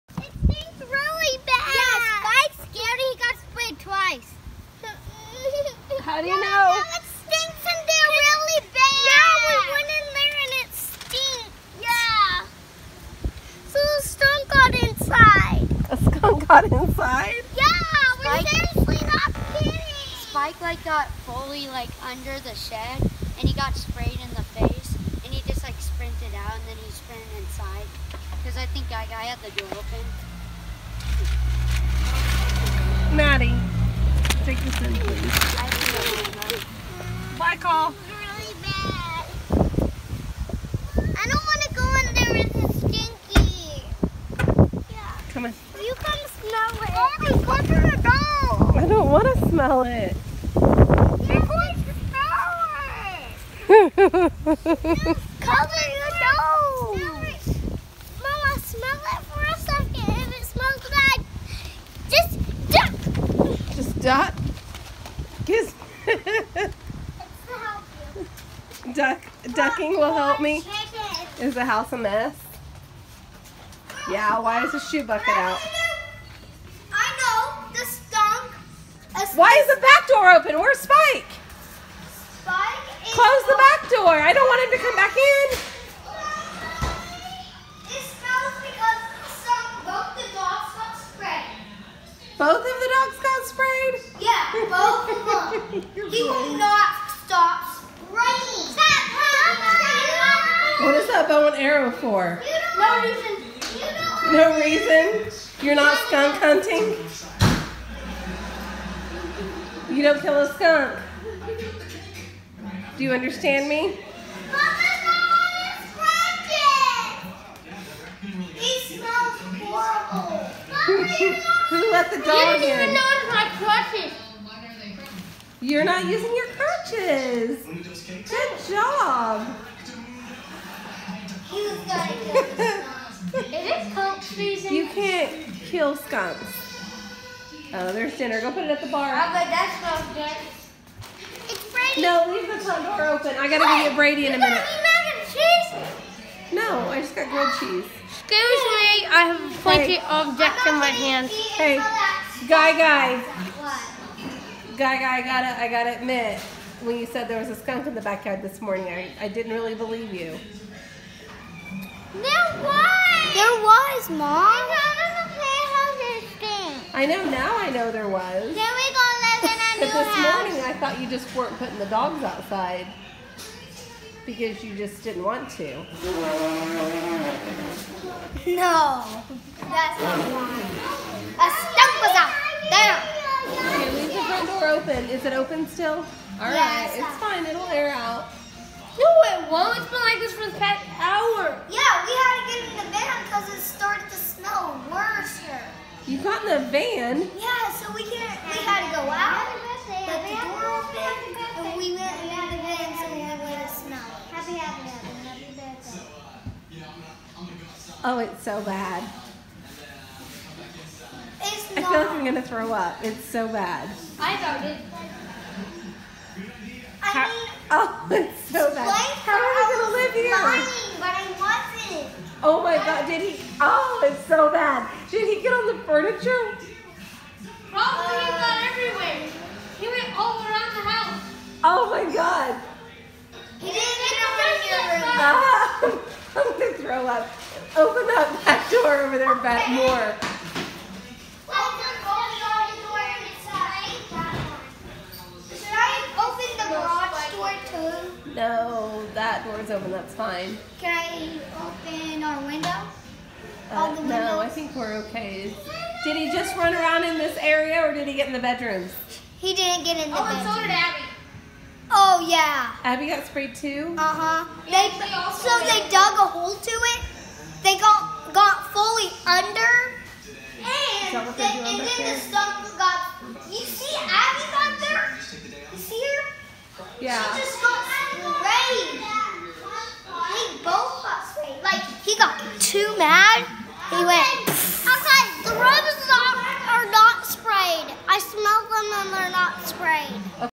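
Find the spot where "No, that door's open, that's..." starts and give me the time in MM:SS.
04:08.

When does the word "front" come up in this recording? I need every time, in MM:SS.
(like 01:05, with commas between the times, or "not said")
02:22, 03:04.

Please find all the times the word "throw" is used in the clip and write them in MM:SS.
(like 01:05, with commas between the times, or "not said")
03:32, 03:56.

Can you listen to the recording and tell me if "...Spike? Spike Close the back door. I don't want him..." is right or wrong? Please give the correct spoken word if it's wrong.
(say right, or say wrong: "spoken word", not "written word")
right.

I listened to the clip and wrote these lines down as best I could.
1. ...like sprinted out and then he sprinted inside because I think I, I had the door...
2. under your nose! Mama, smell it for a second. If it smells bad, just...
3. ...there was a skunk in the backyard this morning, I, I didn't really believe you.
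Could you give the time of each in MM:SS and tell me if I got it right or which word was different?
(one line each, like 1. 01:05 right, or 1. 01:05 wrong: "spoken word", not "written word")
1. 00:25 right
2. 00:55 wrong: "cover", not "under"
3. 02:37 right.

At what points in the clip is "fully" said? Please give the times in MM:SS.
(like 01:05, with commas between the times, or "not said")
00:21, 04:28.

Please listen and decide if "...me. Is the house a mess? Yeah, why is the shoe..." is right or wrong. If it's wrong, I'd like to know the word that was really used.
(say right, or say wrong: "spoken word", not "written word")
right.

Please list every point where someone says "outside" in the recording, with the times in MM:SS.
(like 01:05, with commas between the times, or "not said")
00:17, 02:52.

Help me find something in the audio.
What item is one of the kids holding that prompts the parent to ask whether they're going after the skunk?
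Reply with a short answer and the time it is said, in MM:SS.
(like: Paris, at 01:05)
Bow and arrow, at 01:41.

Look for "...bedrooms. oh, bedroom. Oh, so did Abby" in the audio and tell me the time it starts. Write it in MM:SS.
04:20.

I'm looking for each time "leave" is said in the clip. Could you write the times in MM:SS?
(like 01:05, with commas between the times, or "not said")
02:22, 03:03.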